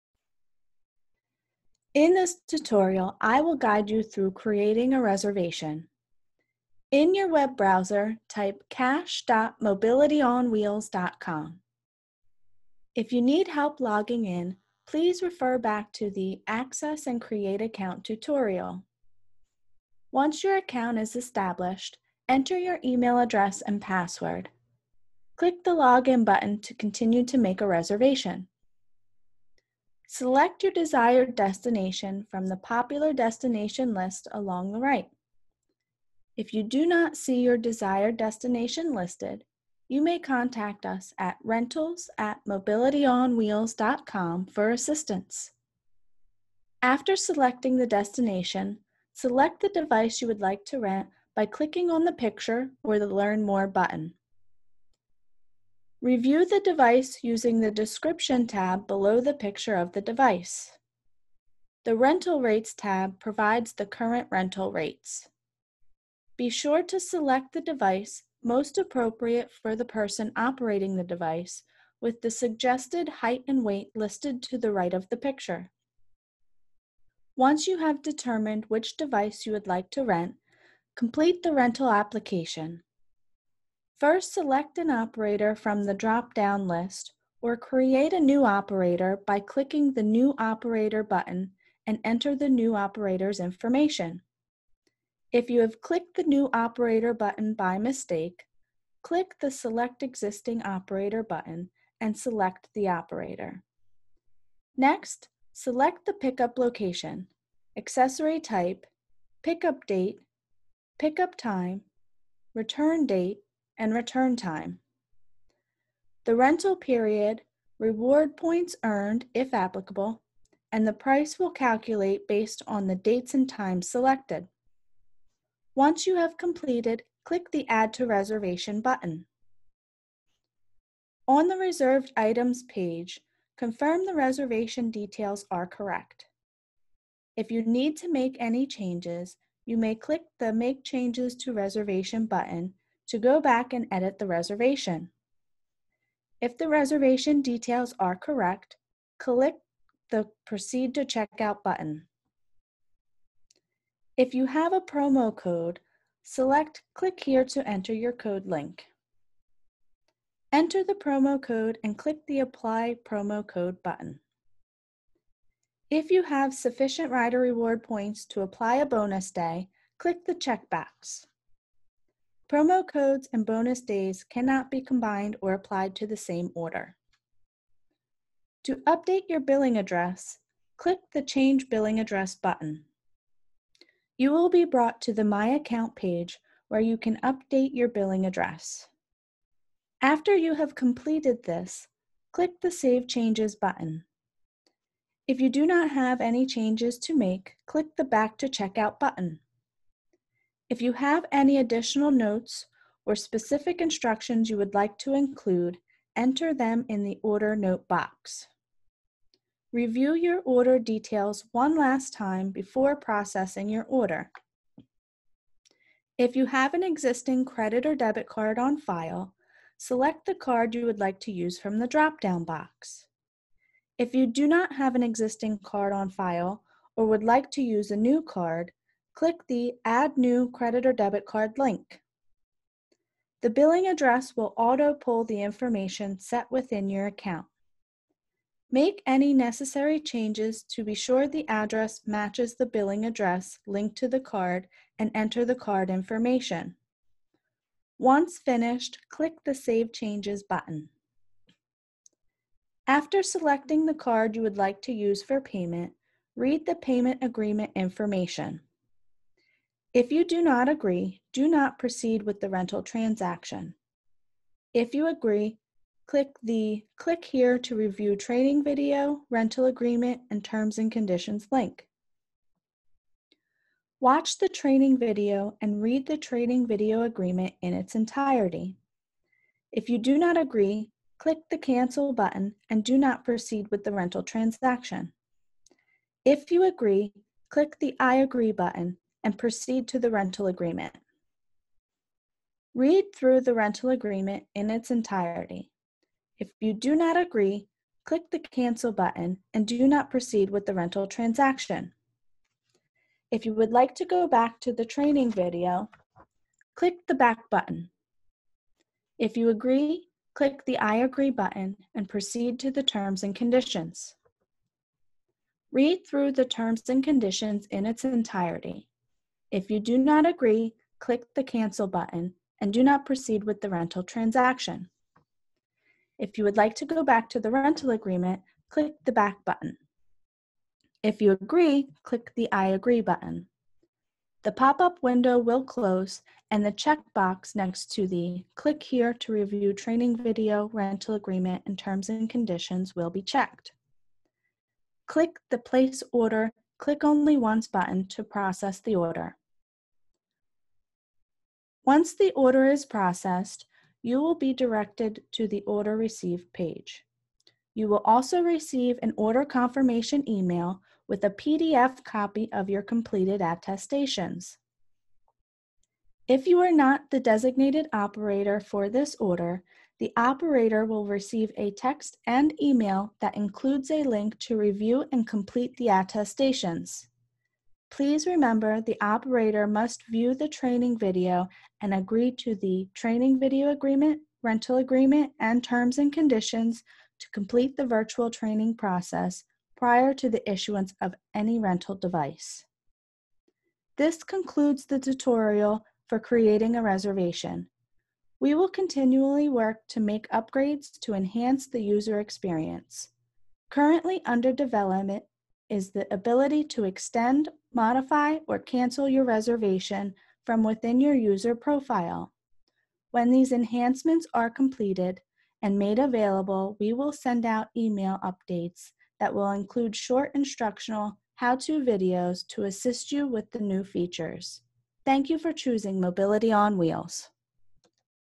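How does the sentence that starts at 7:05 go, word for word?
Thank you for choosing Mobility on Wheels.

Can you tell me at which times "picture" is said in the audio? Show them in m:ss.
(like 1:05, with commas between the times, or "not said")
0:52, 0:59, 1:15.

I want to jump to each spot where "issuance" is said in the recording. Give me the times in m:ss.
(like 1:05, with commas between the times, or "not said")
6:30.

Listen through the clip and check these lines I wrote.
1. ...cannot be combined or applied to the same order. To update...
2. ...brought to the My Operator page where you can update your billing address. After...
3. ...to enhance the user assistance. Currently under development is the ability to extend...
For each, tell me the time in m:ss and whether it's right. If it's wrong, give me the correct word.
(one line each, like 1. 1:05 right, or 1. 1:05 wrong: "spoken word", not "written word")
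1. 2:54 right
2. 3:04 wrong: "Account", not "Operator"
3. 6:41 wrong: "experience", not "assistance".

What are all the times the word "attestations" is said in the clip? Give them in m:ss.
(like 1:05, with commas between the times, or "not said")
6:03, 6:15.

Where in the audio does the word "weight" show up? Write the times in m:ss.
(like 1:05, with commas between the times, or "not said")
1:13.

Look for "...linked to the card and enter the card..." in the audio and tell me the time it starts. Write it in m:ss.
4:03.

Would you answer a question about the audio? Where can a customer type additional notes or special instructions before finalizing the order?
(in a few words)
order note box.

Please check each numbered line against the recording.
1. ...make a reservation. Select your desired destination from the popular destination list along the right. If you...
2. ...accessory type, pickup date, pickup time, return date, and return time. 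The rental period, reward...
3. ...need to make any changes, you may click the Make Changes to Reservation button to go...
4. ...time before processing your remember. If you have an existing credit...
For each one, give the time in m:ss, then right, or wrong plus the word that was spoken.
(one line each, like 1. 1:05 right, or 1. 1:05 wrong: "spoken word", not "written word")
1. 0:27 right
2. 1:47 right
3. 2:17 right
4. 3:32 wrong: "order", not "remember".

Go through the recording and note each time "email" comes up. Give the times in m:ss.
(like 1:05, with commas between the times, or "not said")
0:22, 6:00, 6:12, 6:57.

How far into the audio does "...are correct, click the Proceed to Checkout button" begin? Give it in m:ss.
2:27.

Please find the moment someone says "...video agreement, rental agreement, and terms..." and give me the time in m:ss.
6:23.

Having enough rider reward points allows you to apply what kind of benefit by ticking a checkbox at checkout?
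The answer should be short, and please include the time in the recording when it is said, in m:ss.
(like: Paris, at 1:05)
bonus day, at 2:48.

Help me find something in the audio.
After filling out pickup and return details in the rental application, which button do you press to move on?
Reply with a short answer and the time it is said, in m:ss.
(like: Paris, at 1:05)
Add to Reservation, at 2:07.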